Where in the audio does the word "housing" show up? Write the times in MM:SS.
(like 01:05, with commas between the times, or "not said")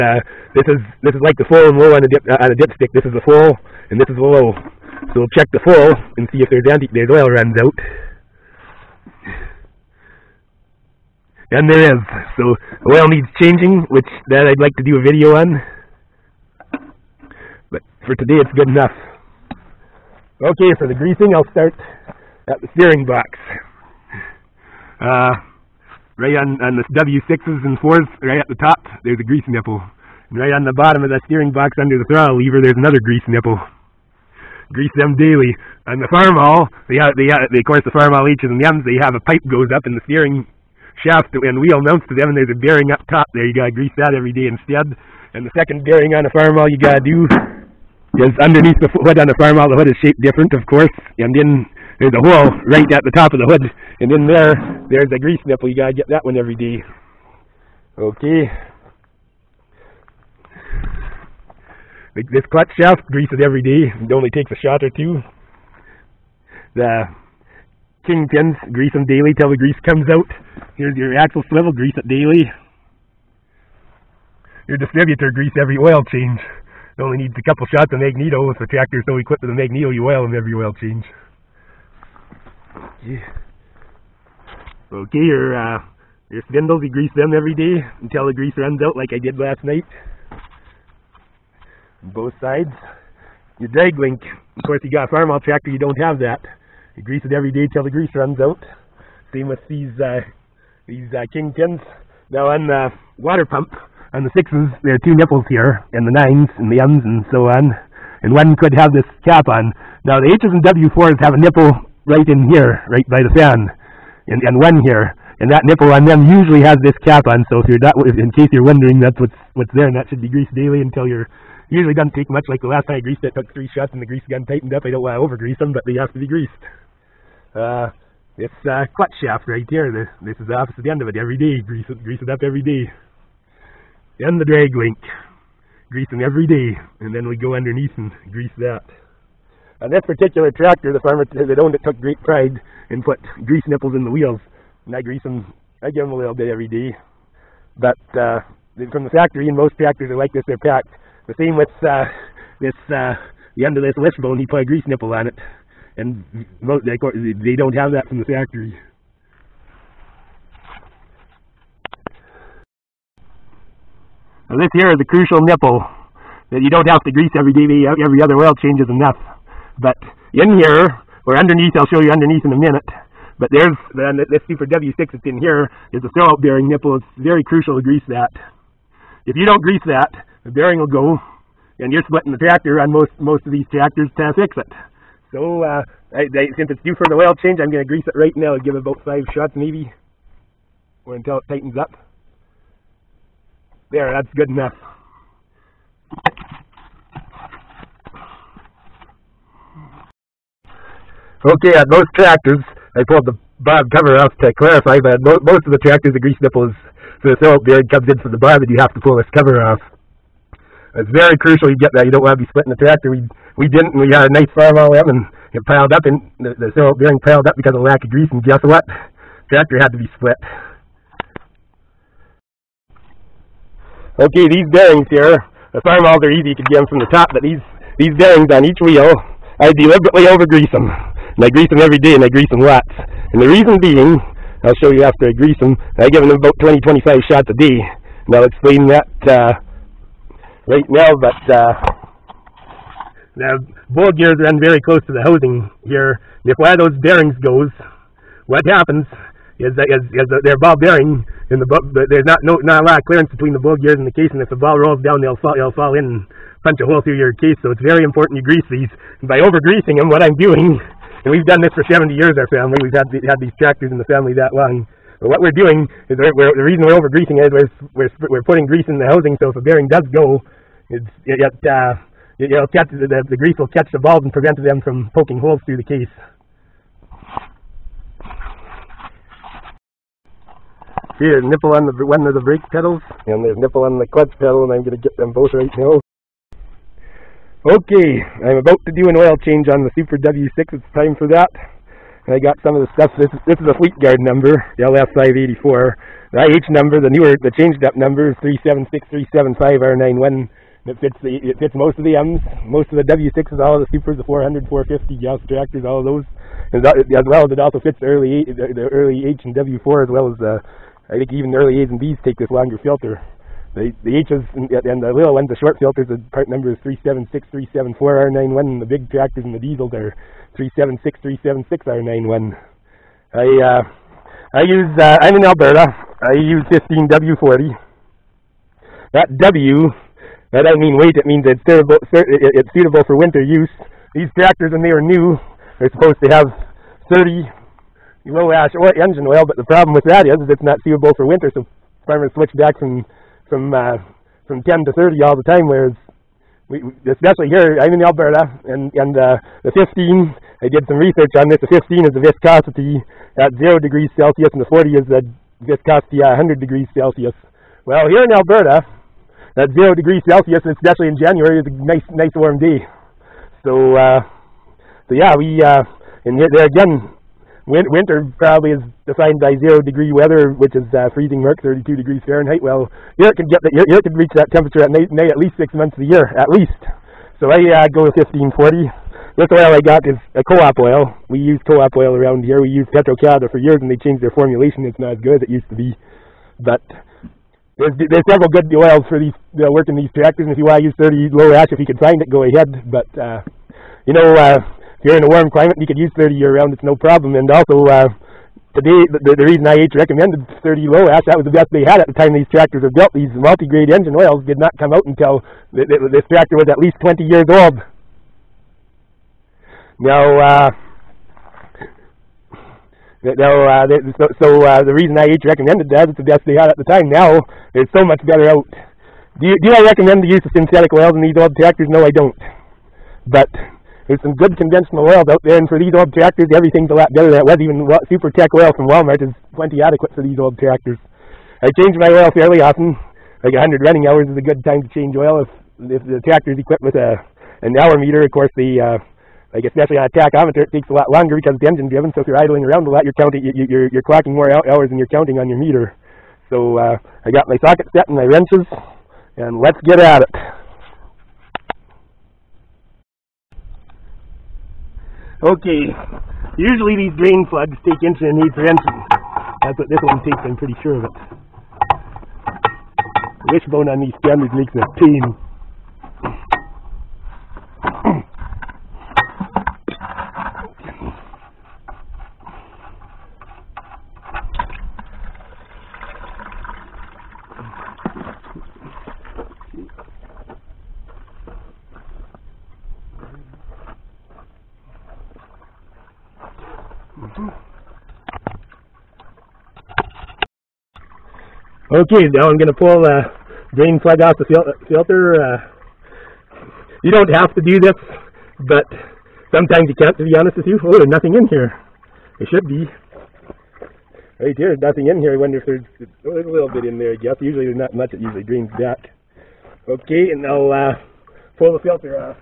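04:05, 04:29.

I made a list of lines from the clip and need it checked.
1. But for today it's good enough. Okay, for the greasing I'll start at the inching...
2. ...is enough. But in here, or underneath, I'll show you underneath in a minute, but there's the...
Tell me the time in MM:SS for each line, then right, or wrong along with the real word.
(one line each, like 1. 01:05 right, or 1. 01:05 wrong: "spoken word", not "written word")
1. 00:17 wrong: "steering", not "inching"
2. 02:48 right.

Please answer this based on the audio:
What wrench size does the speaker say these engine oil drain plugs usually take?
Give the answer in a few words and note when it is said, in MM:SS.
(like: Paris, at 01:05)
1 1/8 inch, at 07:38.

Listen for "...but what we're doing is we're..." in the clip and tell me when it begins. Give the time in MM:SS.
04:25.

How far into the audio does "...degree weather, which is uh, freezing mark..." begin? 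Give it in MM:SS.
06:09.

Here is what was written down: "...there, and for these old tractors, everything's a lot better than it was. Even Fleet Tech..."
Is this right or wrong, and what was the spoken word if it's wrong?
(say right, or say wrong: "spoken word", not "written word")
wrong: "Super", not "Fleet".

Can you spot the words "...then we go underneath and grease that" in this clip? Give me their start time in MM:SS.
02:17.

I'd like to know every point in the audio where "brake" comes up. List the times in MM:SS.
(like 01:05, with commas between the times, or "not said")
04:42.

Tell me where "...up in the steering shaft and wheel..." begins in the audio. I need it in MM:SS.
00:39.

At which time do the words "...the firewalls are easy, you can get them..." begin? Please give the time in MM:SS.
03:45.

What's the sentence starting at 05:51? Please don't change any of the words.
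The 15 is the viscosity at zero degrees Celsius, and the 40 is the viscosity at 100 degrees Celsius.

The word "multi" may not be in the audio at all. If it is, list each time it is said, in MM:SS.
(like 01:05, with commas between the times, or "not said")
06:43.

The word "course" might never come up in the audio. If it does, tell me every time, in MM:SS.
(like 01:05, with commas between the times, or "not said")
00:37, 00:50, 01:34, 07:18.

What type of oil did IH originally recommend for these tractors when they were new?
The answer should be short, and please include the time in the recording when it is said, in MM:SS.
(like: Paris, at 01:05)
30 low ash, at 05:37.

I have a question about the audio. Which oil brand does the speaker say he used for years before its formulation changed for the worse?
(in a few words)
Petro-Canada.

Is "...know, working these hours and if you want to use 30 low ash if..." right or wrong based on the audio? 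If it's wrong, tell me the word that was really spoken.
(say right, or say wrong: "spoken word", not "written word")
wrong: "tractors", not "hours".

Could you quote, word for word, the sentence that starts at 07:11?
I change my oil fairly often.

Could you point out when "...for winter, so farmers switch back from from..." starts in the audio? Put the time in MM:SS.
05:41.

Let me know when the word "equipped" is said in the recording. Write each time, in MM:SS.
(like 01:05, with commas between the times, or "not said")
01:19, 07:16.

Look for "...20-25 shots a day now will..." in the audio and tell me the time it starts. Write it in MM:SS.
03:56.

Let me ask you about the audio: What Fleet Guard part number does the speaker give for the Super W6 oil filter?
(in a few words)
LS584.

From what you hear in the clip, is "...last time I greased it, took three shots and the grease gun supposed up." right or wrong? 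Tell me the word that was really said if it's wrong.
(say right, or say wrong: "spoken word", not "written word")
wrong: "tightened", not "supposed".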